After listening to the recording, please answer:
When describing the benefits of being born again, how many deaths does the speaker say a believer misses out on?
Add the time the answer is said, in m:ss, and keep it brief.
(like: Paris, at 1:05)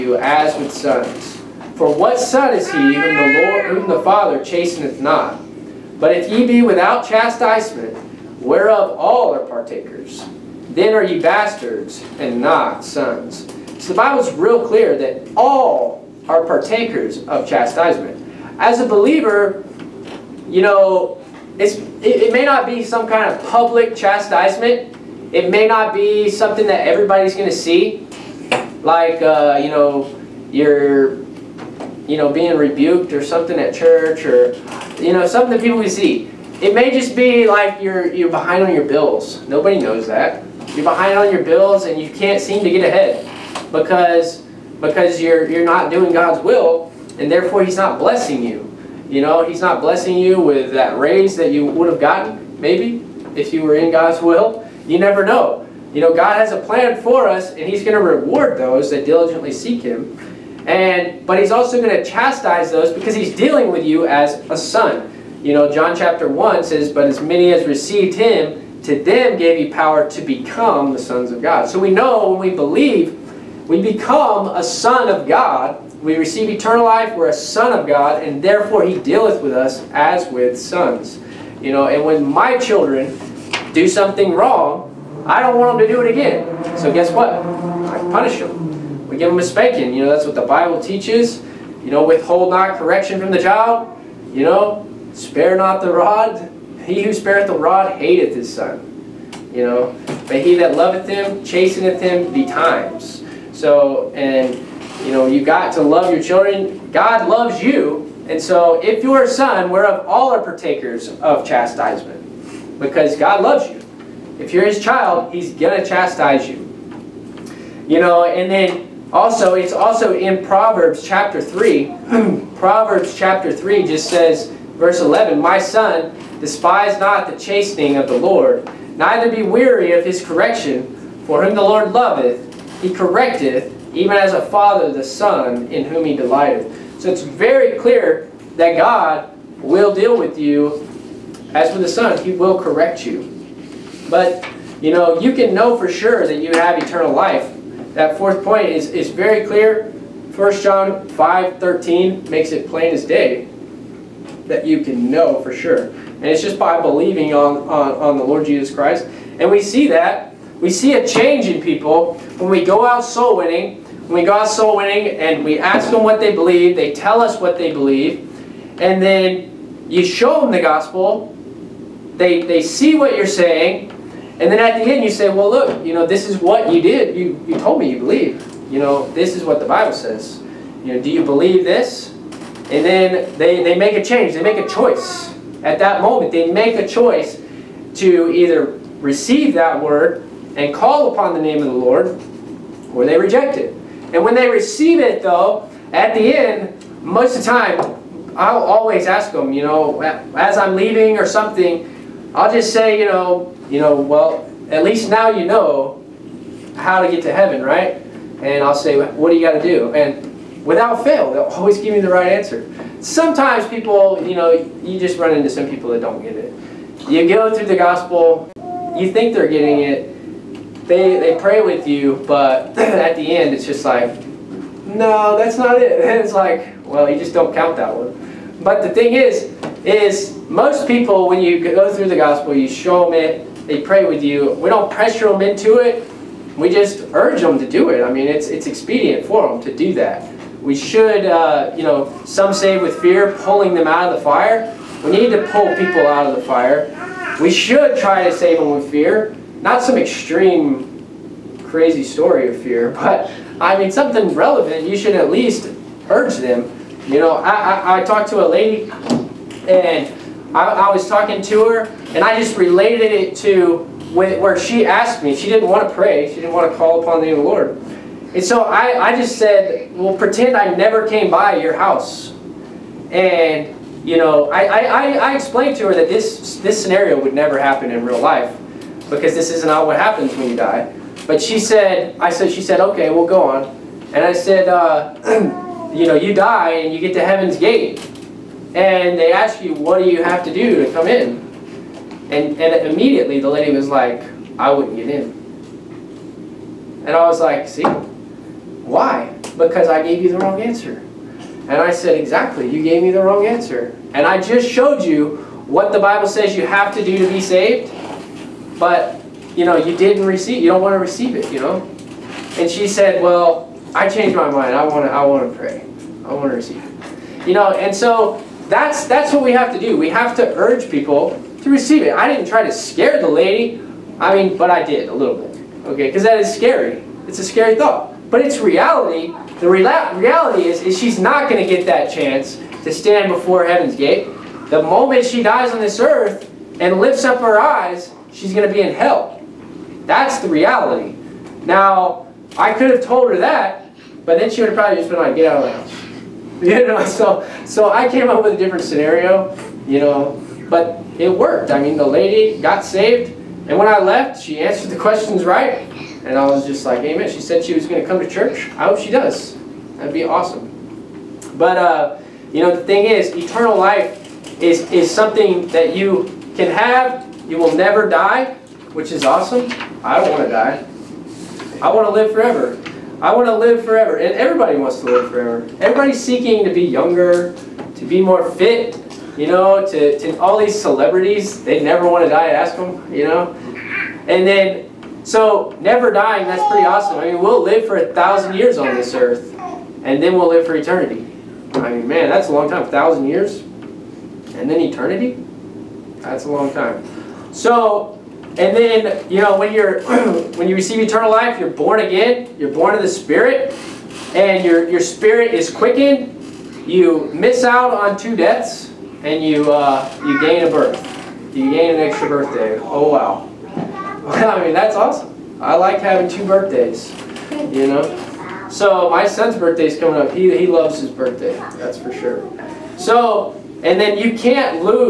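2, at 6:48.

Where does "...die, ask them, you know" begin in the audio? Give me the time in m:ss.
6:22.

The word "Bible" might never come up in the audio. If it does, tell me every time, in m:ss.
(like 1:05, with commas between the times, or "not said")
0:13, 1:30, 2:59, 5:05.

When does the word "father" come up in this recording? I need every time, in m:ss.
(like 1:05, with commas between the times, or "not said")
0:04, 2:14.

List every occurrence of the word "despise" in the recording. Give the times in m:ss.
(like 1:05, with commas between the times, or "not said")
2:06.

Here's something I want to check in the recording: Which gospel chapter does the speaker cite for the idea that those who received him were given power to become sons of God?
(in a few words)
John chapter 1.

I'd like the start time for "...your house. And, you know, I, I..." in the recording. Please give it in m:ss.
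4:31.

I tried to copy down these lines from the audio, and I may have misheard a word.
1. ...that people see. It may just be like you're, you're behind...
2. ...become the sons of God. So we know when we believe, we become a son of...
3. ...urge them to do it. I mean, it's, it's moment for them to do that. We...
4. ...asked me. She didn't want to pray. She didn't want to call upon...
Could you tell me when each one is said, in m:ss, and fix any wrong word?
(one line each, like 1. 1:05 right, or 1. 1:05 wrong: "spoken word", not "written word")
1. 0:35 right
2. 1:10 right
3. 3:57 wrong: "expedient", not "moment"
4. 4:24 right.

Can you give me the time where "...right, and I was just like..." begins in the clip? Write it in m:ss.
5:55.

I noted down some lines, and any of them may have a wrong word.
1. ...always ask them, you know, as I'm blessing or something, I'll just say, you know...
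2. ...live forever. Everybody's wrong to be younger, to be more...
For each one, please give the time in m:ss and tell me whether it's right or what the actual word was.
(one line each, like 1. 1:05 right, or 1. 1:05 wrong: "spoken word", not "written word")
1. 3:18 wrong: "leaving", not "blessing"
2. 6:15 wrong: "seeking", not "wrong".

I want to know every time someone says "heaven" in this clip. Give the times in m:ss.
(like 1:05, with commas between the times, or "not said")
3:27, 4:47, 5:33.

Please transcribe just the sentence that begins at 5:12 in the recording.
And she said, well, I changed my mind.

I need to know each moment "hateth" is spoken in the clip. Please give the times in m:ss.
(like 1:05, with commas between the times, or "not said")
1:38.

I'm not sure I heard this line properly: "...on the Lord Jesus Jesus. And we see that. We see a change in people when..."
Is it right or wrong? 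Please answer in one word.
wrong.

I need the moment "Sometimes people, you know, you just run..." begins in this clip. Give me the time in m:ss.
3:33.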